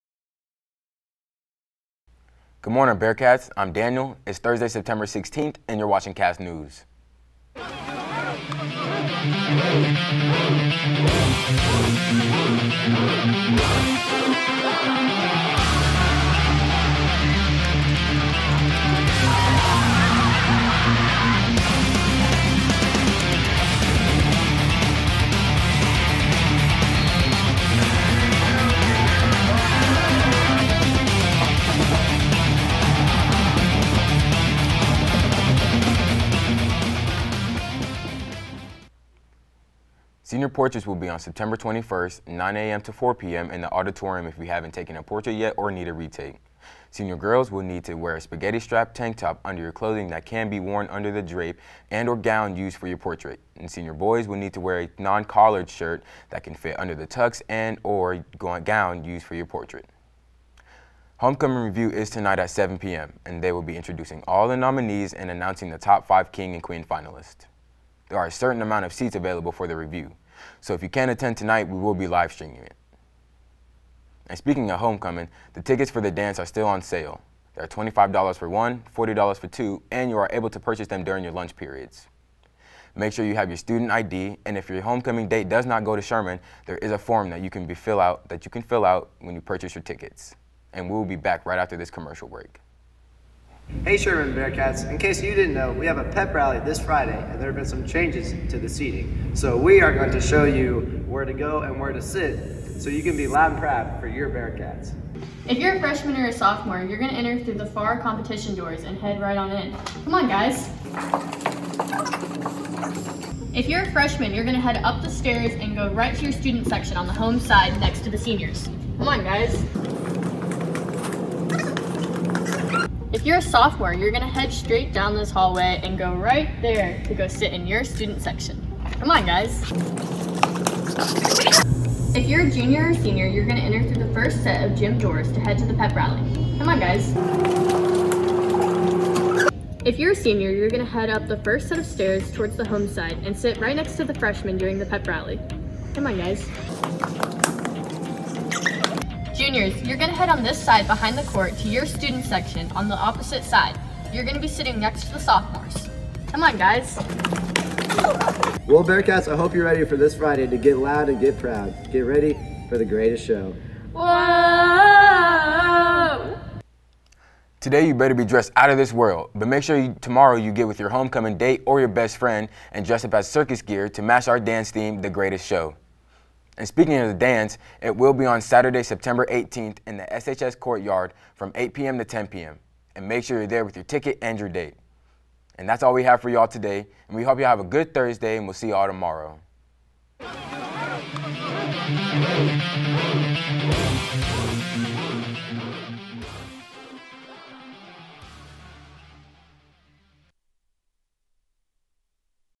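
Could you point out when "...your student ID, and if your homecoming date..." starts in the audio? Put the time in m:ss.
1:23.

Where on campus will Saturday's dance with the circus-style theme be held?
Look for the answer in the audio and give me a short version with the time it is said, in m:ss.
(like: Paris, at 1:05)
SHS Courtyard, at 3:00.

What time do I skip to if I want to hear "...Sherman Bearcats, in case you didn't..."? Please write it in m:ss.
1:33.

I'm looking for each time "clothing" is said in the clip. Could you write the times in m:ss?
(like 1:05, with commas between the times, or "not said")
0:49.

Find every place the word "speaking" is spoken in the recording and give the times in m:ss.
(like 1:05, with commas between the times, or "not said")
1:14, 2:56.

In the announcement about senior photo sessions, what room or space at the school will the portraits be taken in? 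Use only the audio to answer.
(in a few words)
auditorium.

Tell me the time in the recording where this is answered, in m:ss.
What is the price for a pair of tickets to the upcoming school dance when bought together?
1:18.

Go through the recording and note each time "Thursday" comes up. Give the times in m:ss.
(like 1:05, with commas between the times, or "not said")
0:04, 3:07.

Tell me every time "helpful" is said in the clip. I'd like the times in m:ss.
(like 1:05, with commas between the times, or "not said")
not said.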